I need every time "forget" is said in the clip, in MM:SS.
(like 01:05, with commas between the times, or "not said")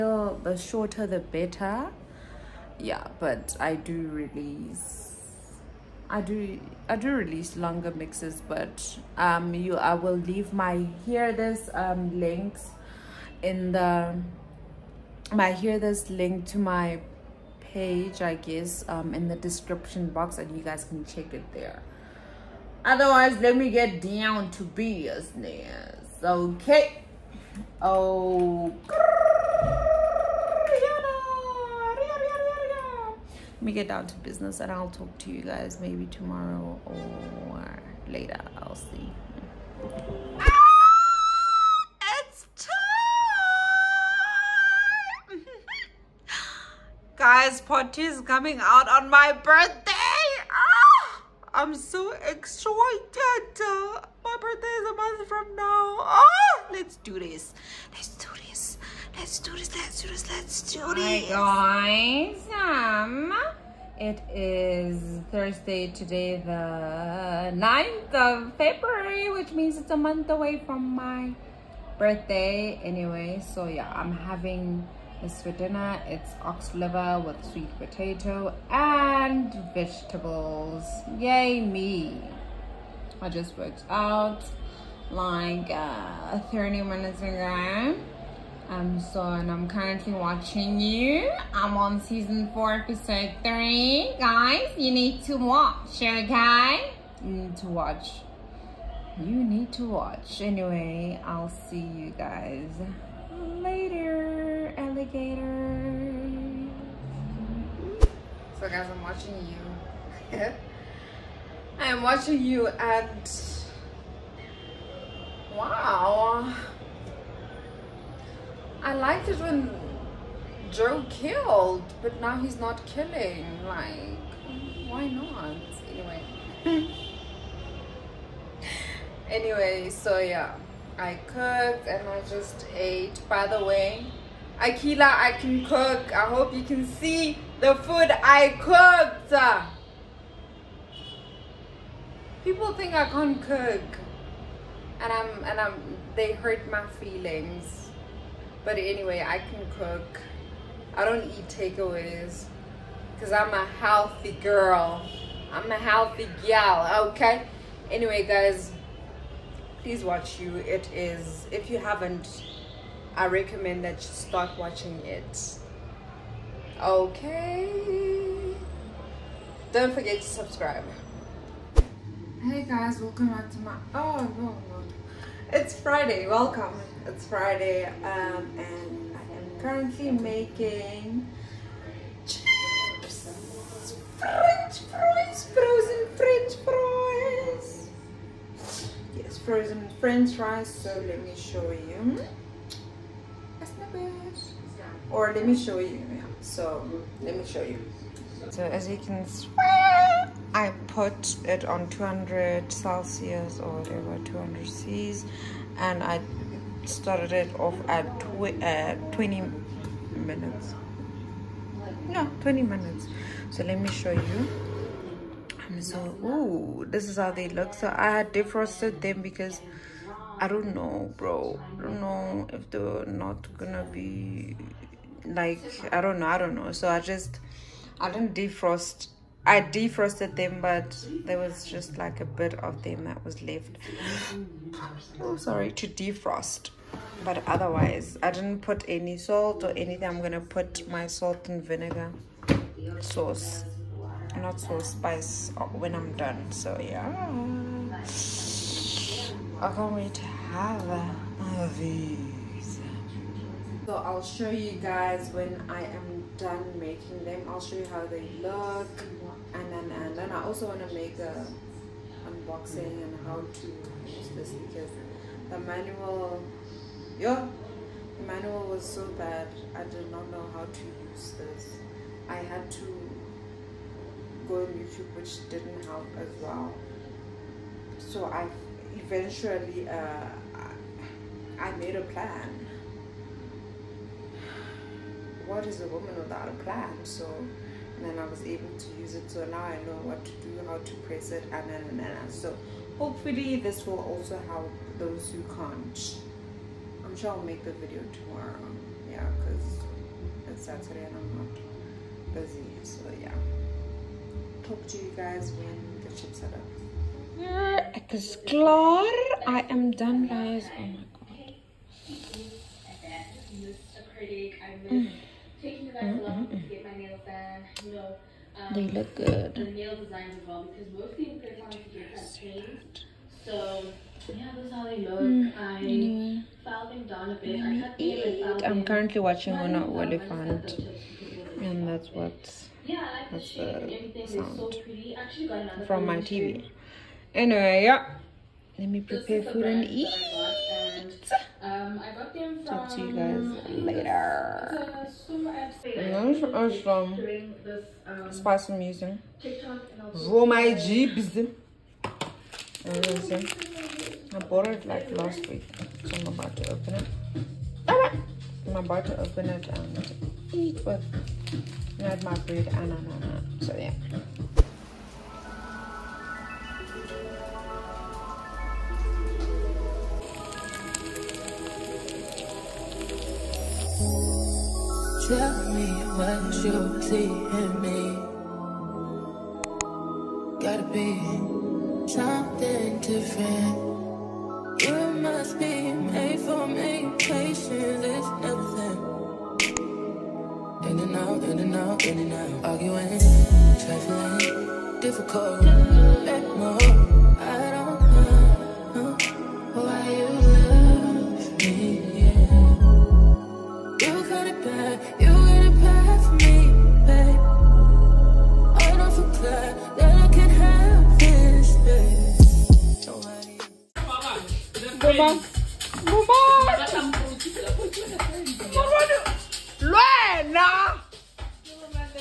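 02:49.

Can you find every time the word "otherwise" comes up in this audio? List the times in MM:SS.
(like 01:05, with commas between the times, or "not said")
00:22, 03:57.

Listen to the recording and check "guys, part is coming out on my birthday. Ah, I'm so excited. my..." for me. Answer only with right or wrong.
right.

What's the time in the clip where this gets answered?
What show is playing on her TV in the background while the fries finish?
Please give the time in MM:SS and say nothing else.
05:29.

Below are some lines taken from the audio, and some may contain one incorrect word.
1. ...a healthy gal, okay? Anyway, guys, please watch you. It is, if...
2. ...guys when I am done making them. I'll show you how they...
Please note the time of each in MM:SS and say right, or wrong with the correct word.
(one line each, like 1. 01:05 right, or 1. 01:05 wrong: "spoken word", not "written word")
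1. 02:35 right
2. 04:14 right.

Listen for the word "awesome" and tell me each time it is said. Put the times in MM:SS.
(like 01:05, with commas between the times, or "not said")
05:46.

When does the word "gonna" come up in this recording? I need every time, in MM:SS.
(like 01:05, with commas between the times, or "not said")
03:43, 04:00.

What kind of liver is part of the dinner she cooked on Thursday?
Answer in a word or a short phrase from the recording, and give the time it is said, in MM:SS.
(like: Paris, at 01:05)
Ox, at 01:16.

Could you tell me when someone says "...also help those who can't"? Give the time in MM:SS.
04:53.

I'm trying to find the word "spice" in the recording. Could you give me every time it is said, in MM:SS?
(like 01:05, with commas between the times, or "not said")
04:04, 05:48.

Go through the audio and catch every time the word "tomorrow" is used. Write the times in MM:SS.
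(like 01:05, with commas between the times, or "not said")
00:36, 04:58.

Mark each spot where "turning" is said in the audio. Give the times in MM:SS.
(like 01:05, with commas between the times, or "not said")
not said.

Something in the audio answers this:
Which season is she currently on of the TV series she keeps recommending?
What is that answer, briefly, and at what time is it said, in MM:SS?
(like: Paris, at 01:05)
Season 4, at 01:32.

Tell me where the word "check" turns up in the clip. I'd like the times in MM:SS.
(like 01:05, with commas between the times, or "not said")
00:21.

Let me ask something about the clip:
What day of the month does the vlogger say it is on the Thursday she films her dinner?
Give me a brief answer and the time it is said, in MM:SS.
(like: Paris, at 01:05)
9th, at 01:06.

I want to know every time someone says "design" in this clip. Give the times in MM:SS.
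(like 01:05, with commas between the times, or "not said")
05:19.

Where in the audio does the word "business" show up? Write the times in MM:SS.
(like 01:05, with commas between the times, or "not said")
00:24, 00:34.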